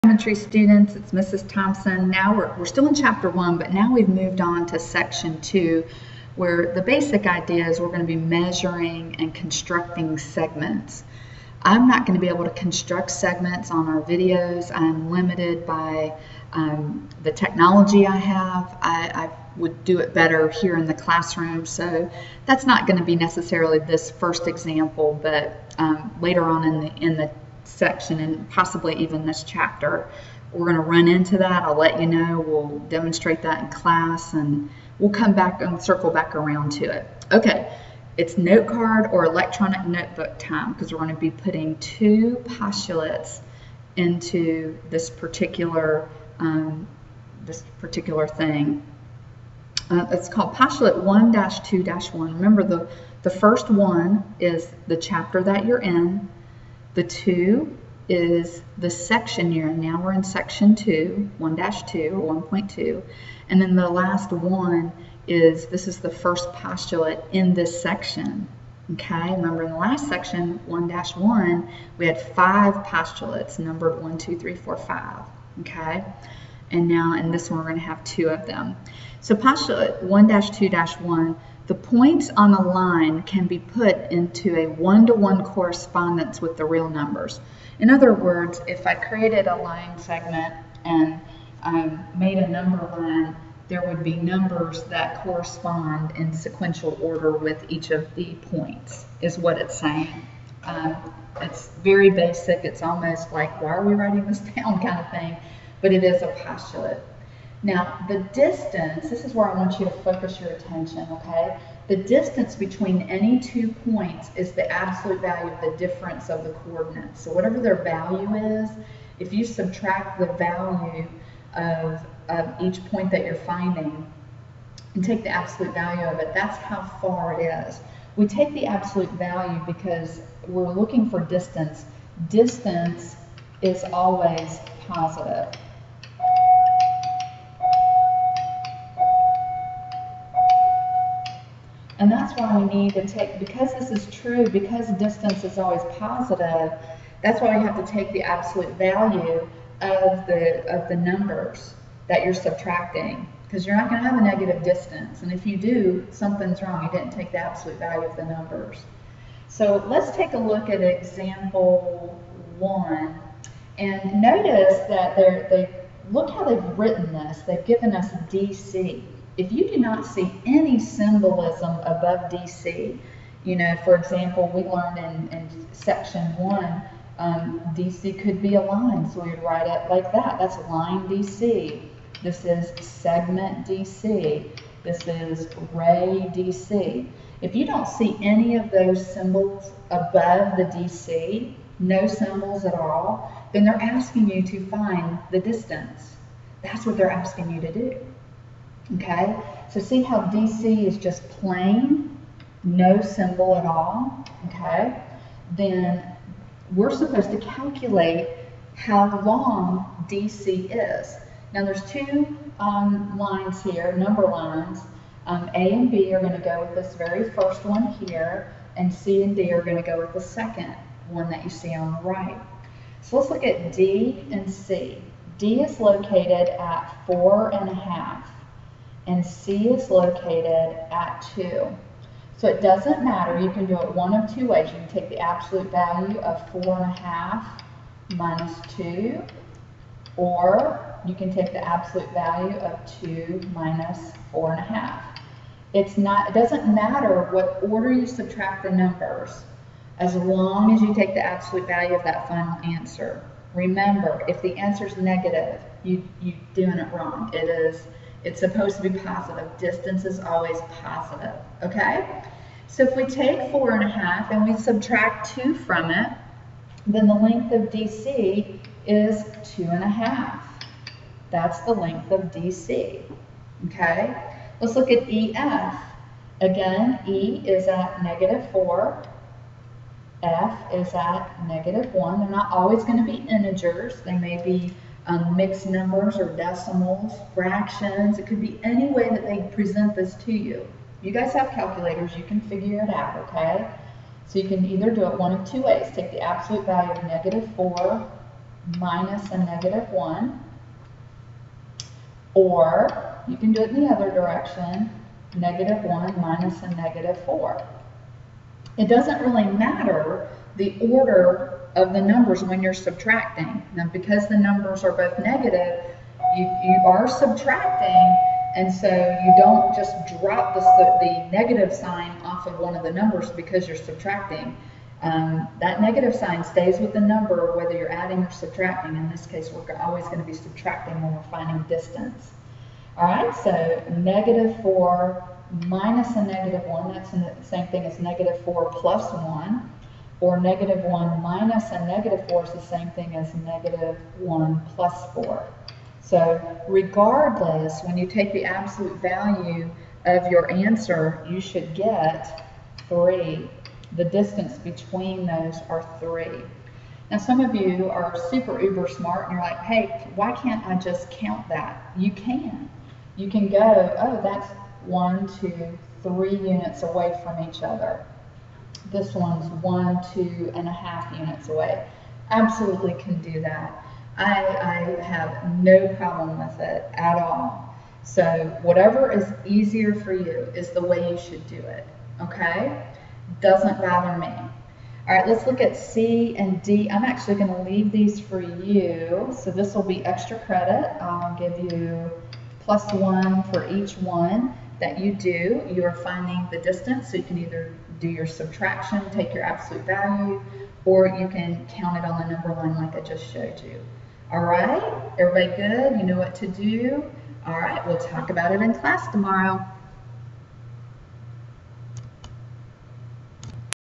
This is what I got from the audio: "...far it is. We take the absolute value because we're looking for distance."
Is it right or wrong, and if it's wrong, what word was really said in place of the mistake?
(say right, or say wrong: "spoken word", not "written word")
right.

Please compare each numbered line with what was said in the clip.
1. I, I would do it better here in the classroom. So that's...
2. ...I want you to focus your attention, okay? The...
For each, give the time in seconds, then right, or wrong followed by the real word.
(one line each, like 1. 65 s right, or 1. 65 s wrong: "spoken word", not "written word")
1. 18 s right
2. 109 s right.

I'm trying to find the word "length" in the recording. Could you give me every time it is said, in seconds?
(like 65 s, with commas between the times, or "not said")
267 s, 271 s.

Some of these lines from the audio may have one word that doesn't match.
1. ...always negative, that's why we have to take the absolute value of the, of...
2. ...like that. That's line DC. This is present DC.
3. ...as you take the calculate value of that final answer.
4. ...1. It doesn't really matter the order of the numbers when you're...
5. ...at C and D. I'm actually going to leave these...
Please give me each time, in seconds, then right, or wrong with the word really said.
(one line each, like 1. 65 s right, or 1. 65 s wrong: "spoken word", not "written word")
1. 145 s wrong: "positive", not "negative"
2. 179 s wrong: "segment", not "present"
3. 250 s wrong: "absolute", not "calculate"
4. 307 s wrong: "4", not "1"
5. 385 s right.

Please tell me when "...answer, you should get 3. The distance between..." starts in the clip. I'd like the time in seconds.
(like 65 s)
350 s.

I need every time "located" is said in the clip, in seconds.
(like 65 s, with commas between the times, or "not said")
225 s, 229 s.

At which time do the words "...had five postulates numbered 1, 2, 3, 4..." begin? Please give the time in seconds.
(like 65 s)
72 s.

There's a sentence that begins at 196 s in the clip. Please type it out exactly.
That's what they're asking you to do.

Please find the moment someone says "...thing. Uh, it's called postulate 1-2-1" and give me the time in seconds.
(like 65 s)
48 s.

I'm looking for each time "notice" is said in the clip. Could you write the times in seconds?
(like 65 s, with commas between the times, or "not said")
164 s.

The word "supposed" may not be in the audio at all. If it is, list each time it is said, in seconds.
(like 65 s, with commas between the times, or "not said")
206 s, 258 s.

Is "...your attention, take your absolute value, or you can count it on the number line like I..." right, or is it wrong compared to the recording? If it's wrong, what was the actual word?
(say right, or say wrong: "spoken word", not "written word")
wrong: "subtraction", not "attention".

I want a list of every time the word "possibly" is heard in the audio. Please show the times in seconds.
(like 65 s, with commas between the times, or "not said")
28 s.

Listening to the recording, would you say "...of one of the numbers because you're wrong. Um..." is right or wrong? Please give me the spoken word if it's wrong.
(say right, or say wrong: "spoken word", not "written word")
wrong: "subtracting", not "wrong".